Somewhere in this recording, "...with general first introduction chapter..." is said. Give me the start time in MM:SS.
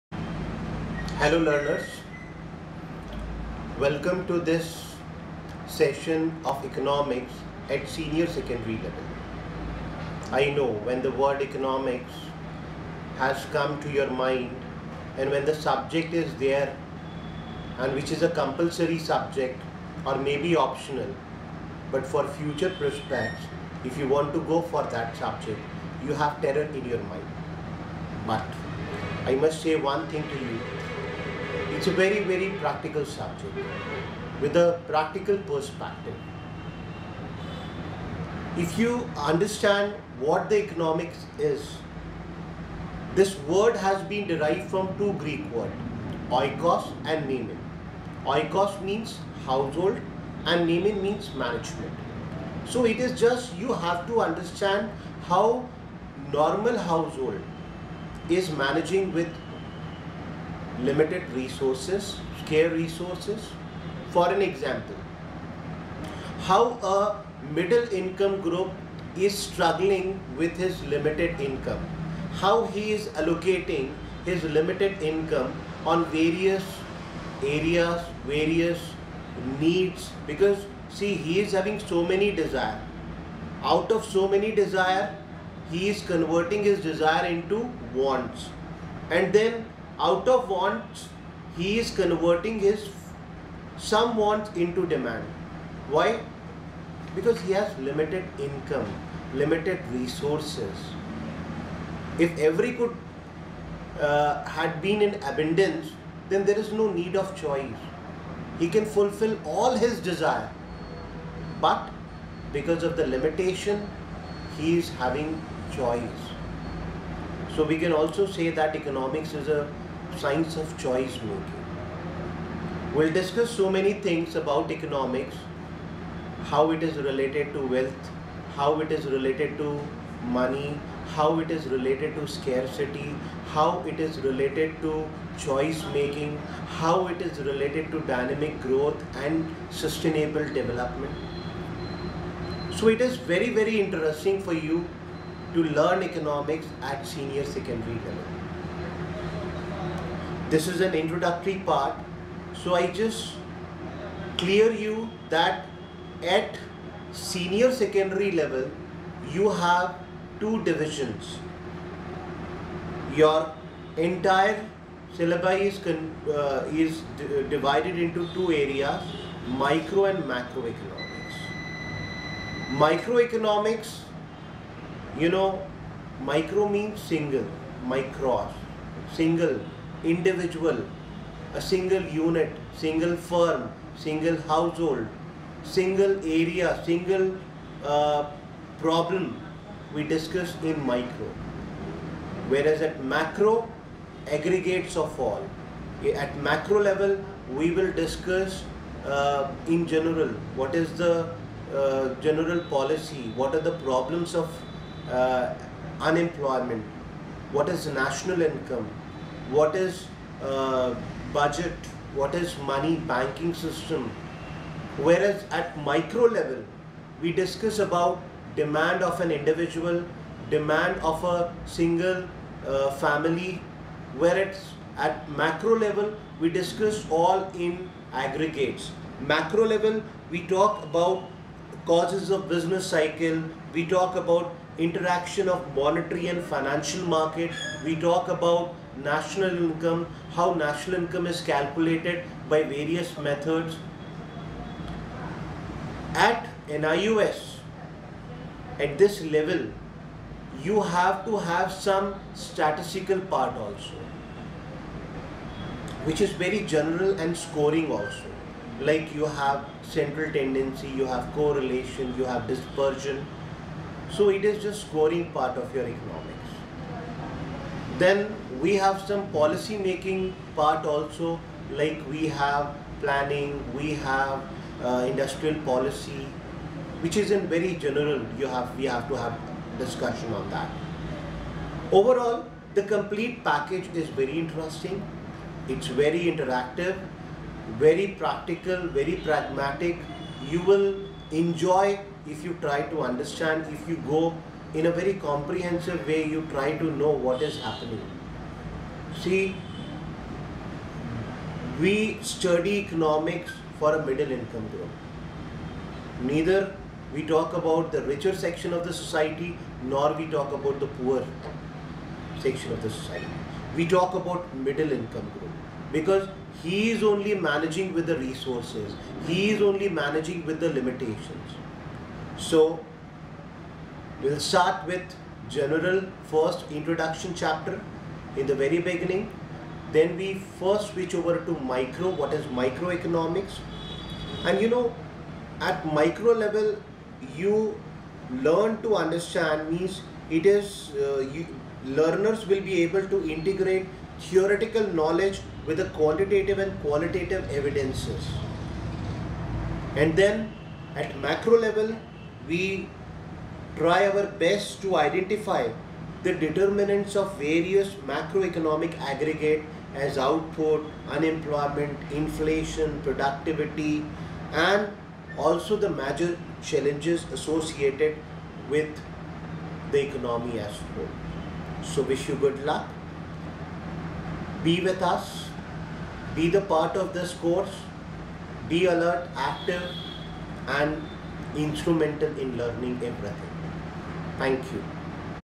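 05:24.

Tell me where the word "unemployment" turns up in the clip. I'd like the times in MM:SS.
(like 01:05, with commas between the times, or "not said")
03:26, 06:01.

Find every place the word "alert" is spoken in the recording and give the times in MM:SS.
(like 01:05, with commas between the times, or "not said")
06:18.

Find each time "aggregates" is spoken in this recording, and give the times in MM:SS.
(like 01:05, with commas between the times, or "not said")
03:14, 03:48, 05:58.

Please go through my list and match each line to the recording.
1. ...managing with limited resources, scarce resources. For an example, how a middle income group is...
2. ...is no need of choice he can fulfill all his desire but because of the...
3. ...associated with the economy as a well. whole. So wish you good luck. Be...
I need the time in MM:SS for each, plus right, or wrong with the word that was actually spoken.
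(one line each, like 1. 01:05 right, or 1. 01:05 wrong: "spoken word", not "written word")
1. 00:58 right
2. 01:46 right
3. 06:07 right.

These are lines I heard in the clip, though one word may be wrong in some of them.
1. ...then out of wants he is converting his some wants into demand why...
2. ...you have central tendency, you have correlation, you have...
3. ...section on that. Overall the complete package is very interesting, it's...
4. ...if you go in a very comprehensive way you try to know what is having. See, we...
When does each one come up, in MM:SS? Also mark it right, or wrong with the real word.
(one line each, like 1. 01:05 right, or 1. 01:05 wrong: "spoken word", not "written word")
1. 01:29 right
2. 04:19 right
3. 04:39 wrong: "discussion", not "section"
4. 04:53 wrong: "happening", not "having".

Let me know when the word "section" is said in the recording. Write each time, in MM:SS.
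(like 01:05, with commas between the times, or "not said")
05:08, 05:12.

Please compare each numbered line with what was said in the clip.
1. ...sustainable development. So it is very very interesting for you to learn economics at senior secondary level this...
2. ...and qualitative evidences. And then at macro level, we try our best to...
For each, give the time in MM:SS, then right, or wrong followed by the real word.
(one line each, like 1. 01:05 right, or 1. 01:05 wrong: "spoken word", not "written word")
1. 02:19 right
2. 05:46 right.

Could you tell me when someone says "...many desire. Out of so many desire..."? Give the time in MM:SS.
01:22.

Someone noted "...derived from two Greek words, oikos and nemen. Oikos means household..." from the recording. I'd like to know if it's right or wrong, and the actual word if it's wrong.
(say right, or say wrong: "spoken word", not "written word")
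right.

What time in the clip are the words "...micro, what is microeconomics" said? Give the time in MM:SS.
05:31.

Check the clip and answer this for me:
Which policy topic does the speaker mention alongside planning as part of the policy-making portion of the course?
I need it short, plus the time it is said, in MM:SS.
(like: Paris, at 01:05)
Industrial policy, at 04:35.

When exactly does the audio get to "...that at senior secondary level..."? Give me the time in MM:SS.
02:35.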